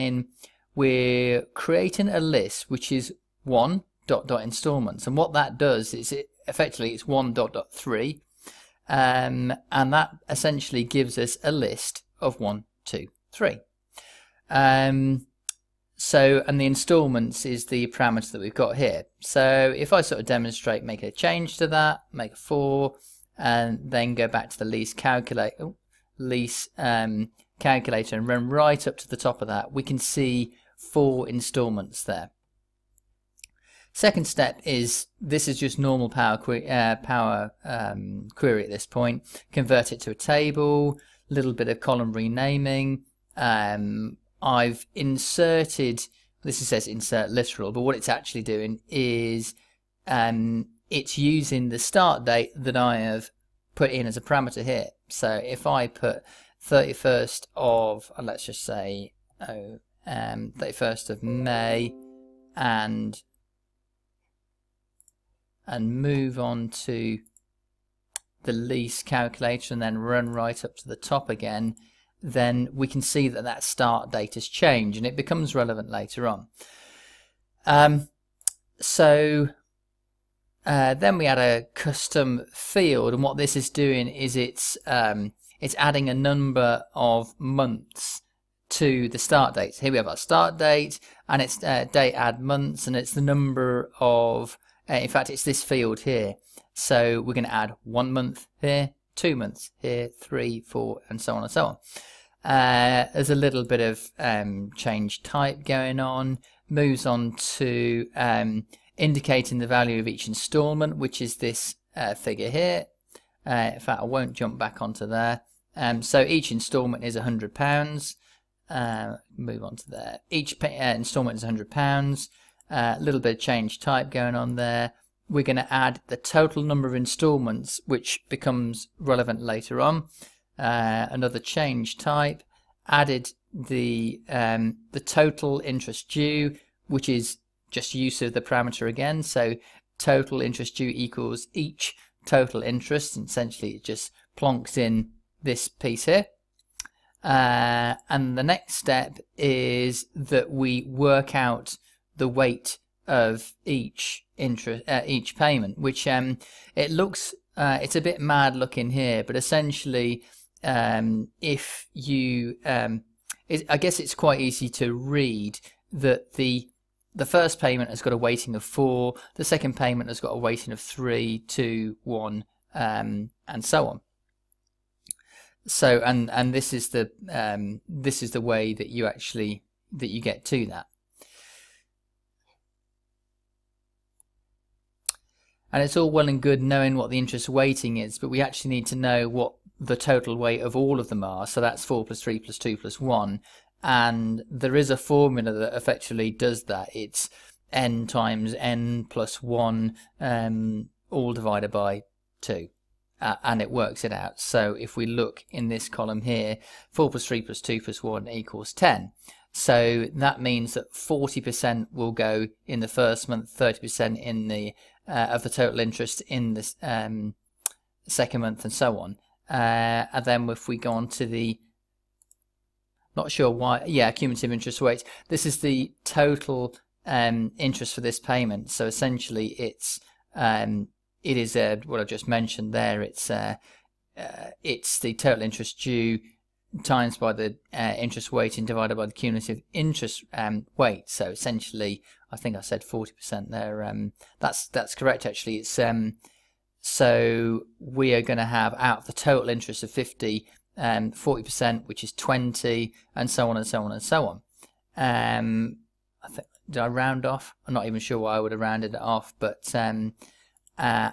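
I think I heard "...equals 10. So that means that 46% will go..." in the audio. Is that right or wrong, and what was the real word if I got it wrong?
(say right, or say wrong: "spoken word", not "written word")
wrong: "40", not "46".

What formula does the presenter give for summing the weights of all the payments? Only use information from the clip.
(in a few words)
n times n plus 1 divided by 2.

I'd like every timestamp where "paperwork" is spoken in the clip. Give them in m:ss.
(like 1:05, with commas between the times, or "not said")
not said.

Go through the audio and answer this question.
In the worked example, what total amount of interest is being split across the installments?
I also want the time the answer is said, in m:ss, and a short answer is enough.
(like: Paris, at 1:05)
50, at 4:09.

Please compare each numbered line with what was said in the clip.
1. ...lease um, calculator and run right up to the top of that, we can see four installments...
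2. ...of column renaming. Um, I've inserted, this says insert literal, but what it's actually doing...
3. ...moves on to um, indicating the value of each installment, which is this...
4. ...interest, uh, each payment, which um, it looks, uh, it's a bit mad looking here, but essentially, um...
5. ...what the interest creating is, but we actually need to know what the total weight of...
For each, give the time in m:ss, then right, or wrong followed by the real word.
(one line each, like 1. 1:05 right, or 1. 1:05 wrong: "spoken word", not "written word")
1. 0:26 right
2. 0:41 right
3. 1:46 right
4. 2:34 right
5. 3:06 wrong: "weighting", not "creating".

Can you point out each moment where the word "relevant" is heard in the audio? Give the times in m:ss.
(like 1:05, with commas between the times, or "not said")
1:15, 2:08.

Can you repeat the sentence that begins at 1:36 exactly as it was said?
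So we're going to add one month here, two months here, three, four, and so on and so on.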